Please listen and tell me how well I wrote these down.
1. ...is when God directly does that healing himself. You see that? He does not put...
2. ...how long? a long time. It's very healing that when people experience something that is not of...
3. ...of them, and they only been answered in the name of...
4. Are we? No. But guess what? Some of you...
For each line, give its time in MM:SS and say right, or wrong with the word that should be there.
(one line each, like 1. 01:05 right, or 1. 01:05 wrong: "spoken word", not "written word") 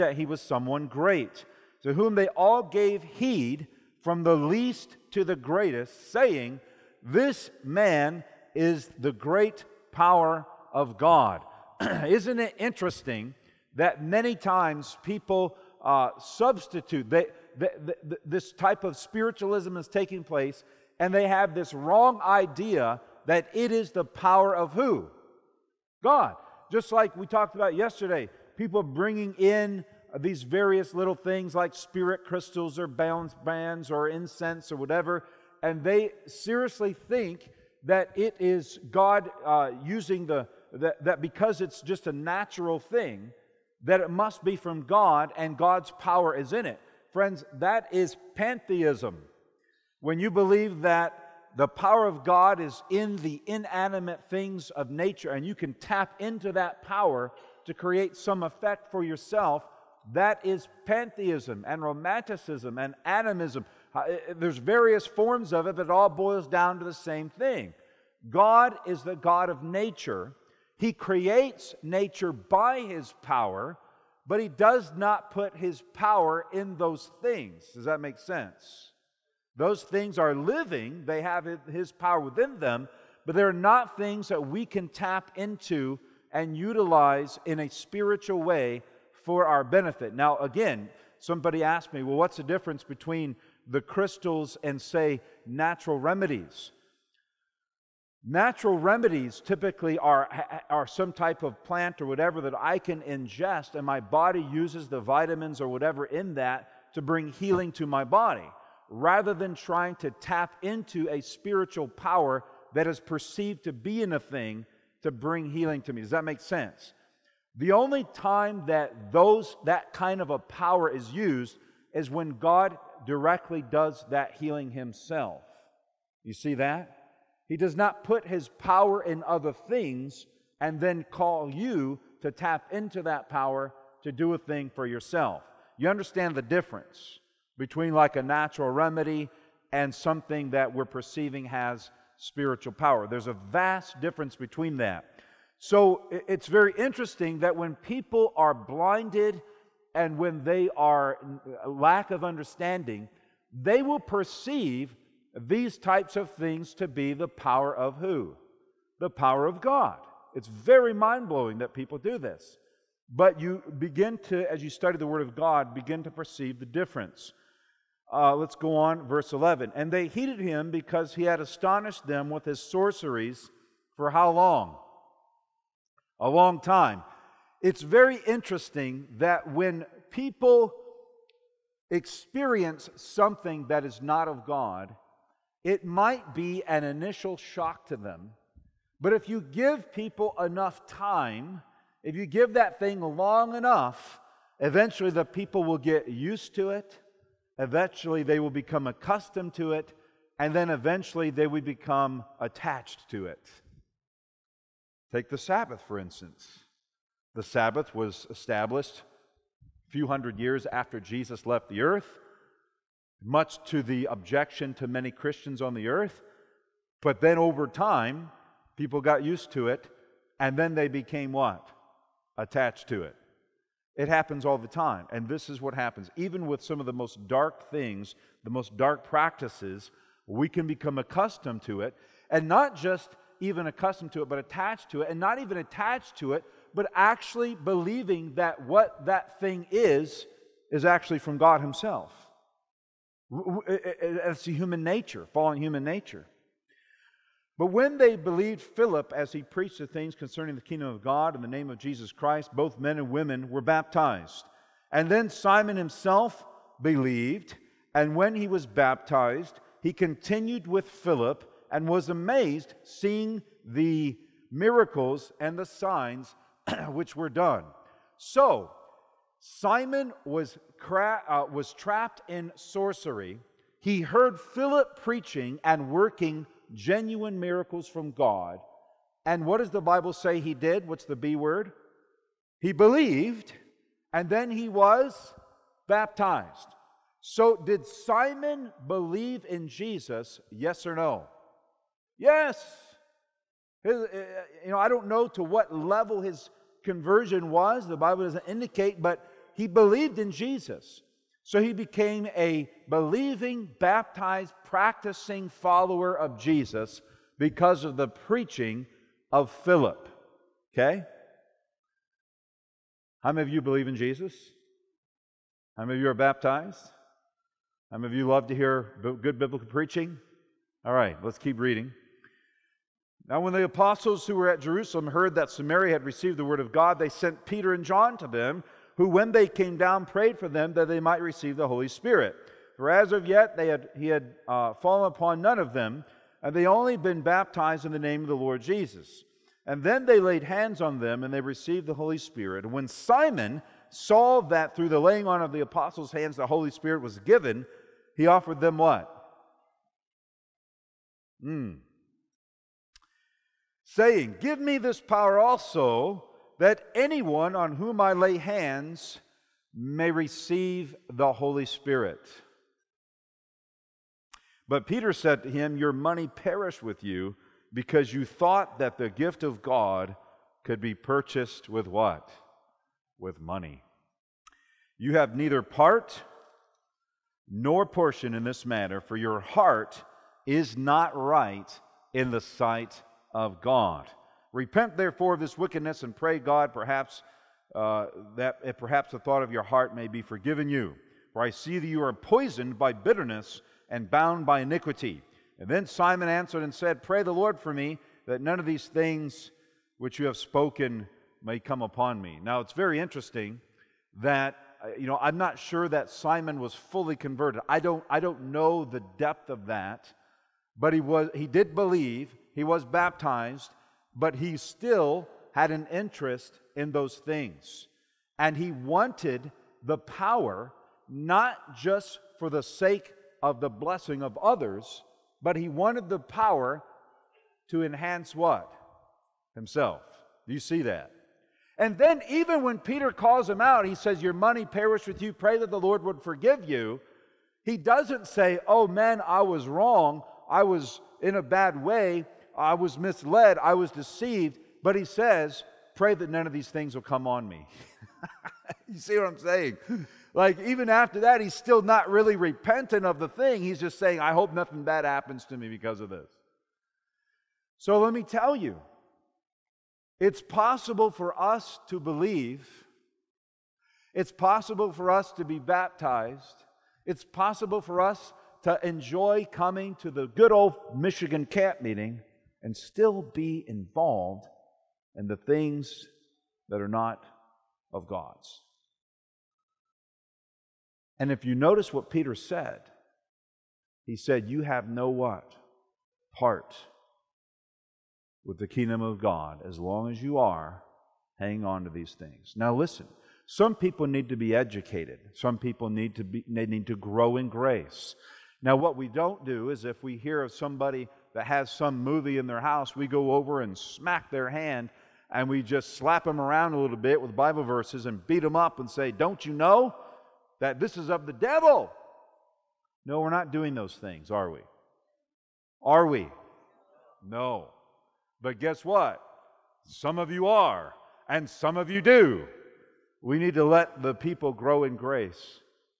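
1. 02:01 right
2. 02:54 wrong: "interesting", not "healing"
3. 05:35 wrong: "baptized", not "answered"
4. 08:35 right.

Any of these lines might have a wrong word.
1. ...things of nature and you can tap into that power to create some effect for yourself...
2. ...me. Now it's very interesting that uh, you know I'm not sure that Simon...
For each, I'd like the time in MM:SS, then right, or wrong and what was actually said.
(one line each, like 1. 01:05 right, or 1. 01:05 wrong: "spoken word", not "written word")
1. 00:54 right
2. 06:42 right.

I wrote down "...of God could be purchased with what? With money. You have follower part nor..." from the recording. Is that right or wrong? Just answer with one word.
wrong.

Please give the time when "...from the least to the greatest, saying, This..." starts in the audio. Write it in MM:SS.
00:04.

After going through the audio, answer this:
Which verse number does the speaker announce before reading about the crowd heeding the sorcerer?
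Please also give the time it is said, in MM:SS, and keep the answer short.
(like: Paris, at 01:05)
11, at 02:49.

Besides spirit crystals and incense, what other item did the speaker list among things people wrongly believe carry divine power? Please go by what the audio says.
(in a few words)
balance bands.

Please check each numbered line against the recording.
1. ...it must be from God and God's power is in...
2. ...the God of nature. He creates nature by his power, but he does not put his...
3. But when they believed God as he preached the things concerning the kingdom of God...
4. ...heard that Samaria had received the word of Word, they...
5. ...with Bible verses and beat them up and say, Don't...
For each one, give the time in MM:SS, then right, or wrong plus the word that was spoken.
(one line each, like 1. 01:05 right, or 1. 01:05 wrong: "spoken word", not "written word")
1. 00:44 right
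2. 01:09 right
3. 04:07 wrong: "Philip", not "God"
4. 05:25 wrong: "God", not "Word"
5. 08:27 right.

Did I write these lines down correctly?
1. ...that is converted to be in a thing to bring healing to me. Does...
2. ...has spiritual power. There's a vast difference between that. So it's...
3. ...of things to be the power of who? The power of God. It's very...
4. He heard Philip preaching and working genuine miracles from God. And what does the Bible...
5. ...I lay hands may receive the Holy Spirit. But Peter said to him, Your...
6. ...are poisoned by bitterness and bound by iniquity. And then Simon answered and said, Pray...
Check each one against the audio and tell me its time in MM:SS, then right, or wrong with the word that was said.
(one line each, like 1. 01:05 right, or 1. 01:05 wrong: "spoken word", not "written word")
1. 01:52 wrong: "perceived", not "converted"
2. 02:21 right
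3. 02:36 right
4. 04:33 right
5. 05:58 right
6. 06:32 right.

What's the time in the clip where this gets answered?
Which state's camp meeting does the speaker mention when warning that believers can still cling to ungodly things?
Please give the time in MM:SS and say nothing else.
07:50.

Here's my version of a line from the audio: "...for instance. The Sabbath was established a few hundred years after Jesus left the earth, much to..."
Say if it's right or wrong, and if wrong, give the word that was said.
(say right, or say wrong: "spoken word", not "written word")
right.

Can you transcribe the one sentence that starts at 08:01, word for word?
And if you notice what Peter said, he said, You have no what?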